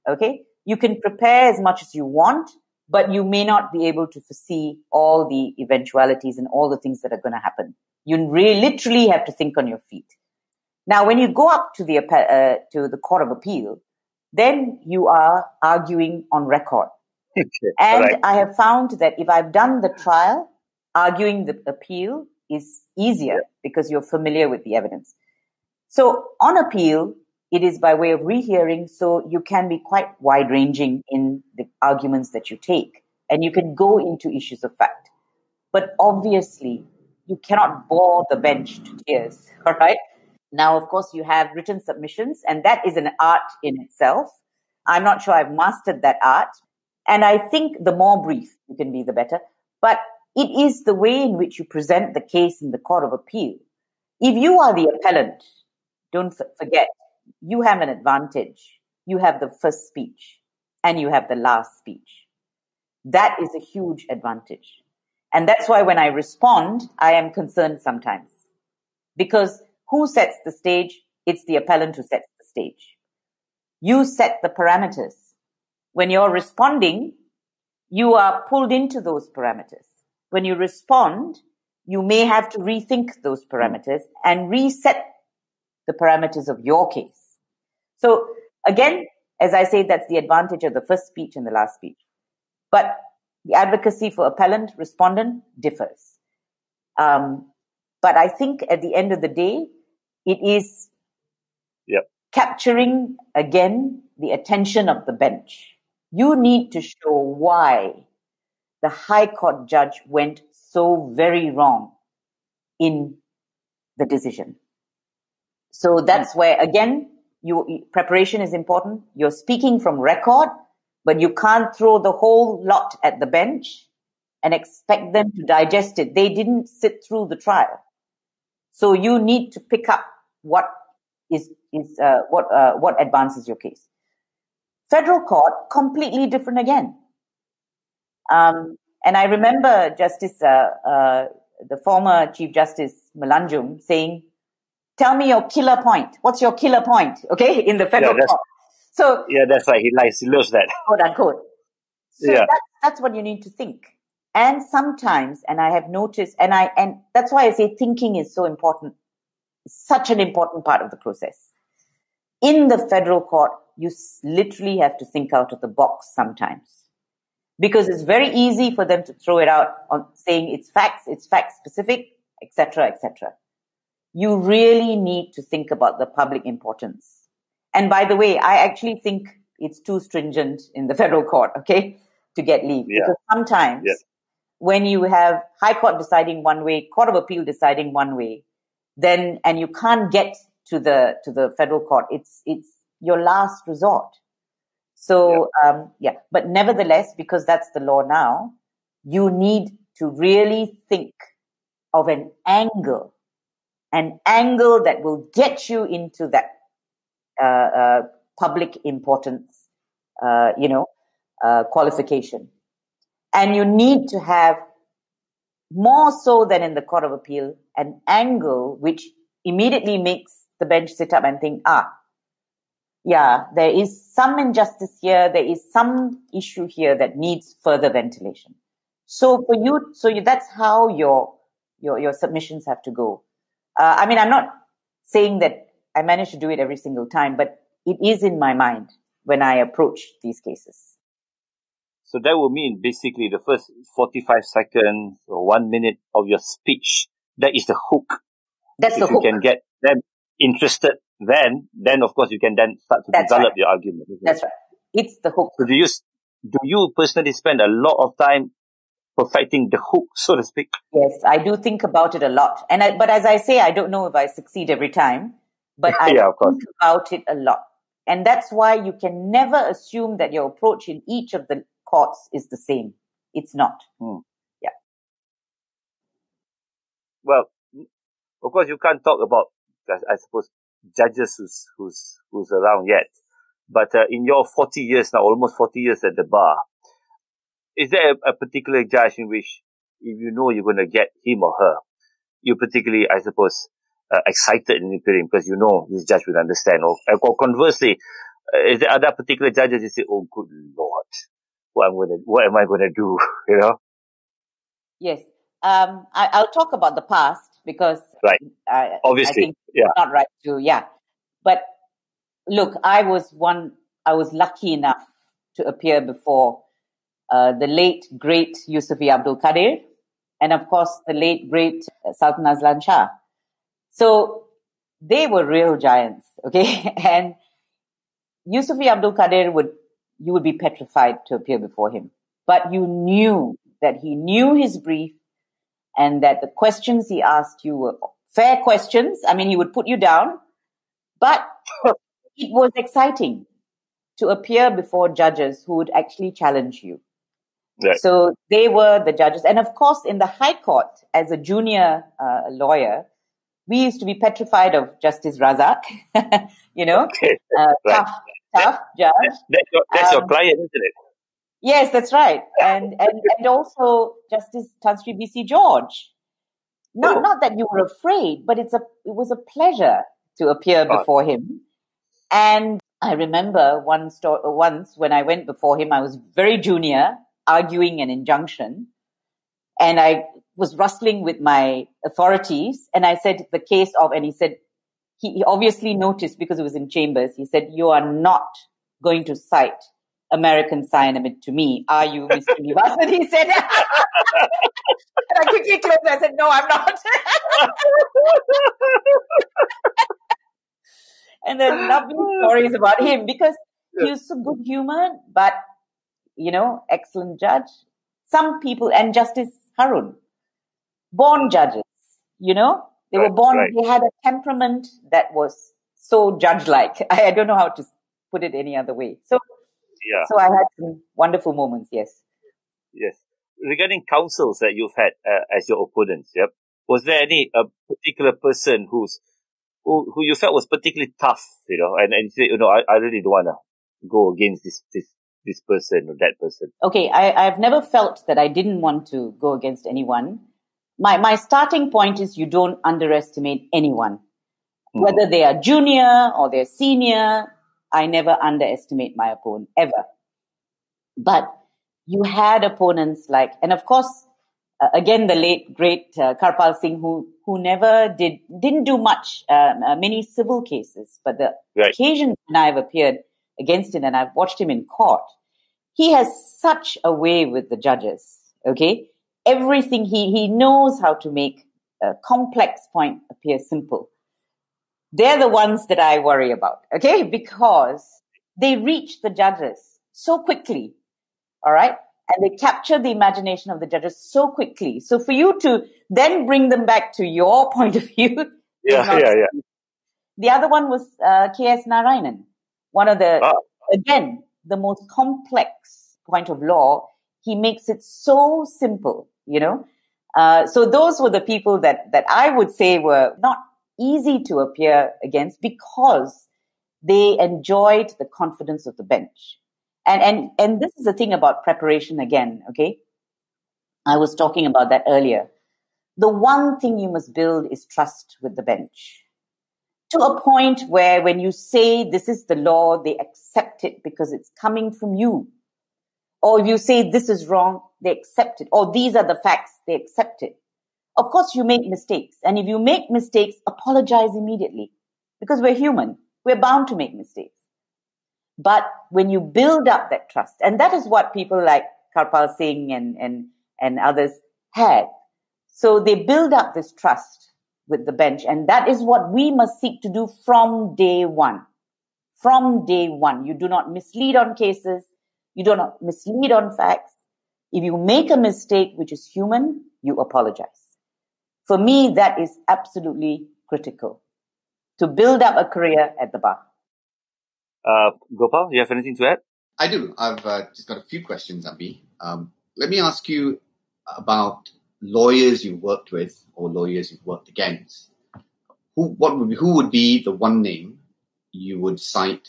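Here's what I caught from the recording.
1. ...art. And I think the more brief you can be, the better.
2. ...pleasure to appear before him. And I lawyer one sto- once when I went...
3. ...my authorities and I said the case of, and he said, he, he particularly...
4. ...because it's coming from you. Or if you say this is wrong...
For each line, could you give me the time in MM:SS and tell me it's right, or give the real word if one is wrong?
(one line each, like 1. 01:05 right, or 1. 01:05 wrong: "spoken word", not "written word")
1. 00:46 right
2. 06:09 wrong: "remember", not "lawyer"
3. 06:21 wrong: "obviously", not "particularly"
4. 08:44 right.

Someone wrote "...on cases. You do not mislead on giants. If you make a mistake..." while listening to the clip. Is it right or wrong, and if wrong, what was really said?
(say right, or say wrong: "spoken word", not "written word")
wrong: "facts", not "giants".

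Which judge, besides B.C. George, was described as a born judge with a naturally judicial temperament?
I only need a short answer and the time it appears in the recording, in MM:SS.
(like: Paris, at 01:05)
Justice Harun, at 06:49.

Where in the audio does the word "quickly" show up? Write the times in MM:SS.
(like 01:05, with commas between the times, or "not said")
06:35, 08:00, 08:04.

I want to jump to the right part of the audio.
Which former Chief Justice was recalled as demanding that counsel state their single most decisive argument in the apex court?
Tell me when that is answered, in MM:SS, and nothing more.
02:23.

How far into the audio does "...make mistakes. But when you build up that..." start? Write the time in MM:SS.
08:56.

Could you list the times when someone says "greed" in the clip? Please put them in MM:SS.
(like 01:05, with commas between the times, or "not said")
not said.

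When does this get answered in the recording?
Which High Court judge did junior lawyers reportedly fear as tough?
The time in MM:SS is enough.
05:55.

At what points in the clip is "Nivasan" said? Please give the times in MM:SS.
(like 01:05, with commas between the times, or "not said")
06:32.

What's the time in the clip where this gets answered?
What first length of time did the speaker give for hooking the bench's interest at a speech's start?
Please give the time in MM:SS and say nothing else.
04:03.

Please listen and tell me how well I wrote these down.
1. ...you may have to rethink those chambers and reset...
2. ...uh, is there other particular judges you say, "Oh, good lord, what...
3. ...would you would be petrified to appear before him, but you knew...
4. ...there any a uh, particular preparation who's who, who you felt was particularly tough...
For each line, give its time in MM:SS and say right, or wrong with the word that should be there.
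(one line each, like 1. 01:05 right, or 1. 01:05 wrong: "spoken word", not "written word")
1. 01:21 wrong: "parameters", not "chambers"
2. 04:58 right
3. 05:29 right
4. 07:07 wrong: "person", not "preparation".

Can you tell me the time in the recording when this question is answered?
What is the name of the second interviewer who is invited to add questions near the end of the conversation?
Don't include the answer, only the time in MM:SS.
09:28.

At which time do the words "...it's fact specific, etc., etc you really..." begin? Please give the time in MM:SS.
02:51.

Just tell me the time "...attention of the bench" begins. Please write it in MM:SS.
01:44.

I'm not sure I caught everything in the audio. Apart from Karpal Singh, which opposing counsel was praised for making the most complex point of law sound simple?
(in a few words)
K.S. Narayanan.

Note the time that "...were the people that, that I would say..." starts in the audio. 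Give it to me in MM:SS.
08:21.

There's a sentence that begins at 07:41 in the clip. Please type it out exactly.
when I've appeared, against him and I've watched him in court.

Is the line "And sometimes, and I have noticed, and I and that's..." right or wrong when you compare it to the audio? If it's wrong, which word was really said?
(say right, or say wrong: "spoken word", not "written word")
right.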